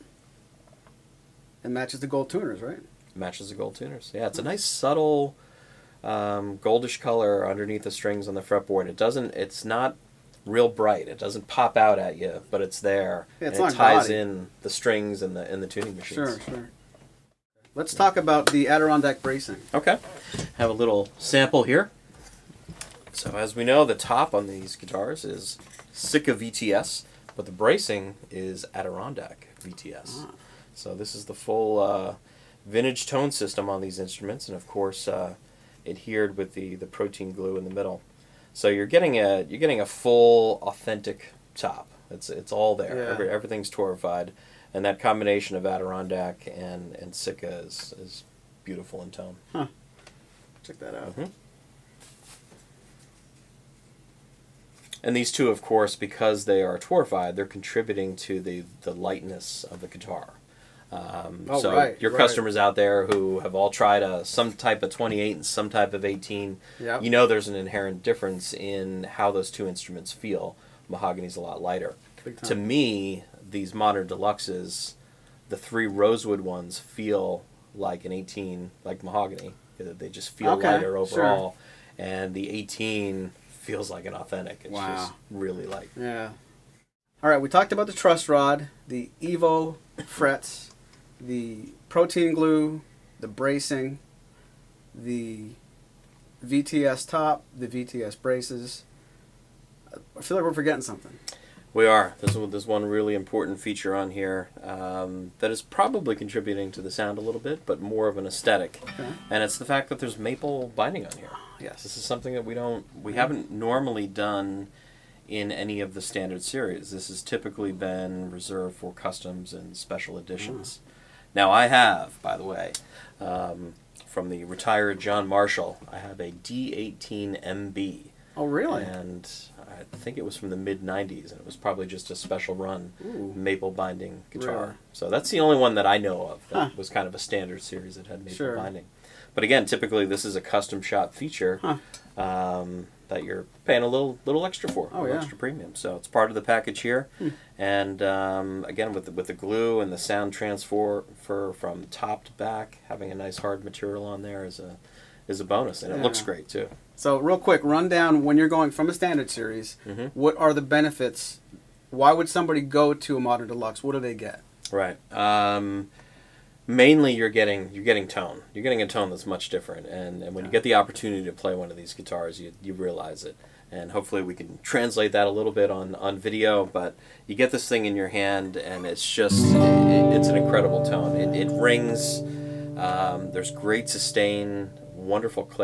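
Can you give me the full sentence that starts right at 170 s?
you get the opportunity to play one of these guitars, you you realize it.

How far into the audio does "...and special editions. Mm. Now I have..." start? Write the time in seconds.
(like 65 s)
119 s.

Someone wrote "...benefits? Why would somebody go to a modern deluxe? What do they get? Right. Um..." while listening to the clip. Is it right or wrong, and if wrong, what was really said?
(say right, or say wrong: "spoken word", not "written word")
right.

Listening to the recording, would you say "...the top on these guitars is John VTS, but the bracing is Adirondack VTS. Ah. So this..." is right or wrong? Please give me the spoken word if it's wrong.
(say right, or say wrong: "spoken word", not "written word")
wrong: "Sitka", not "John".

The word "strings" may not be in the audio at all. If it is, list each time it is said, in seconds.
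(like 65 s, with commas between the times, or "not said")
7 s, 14 s.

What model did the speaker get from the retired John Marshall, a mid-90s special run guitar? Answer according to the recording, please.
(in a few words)
D18MB.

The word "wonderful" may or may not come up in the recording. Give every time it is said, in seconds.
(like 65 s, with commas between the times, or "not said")
184 s.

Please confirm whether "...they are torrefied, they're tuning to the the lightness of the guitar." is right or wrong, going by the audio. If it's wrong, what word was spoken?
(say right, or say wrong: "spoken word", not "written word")
wrong: "contributing", not "tuning".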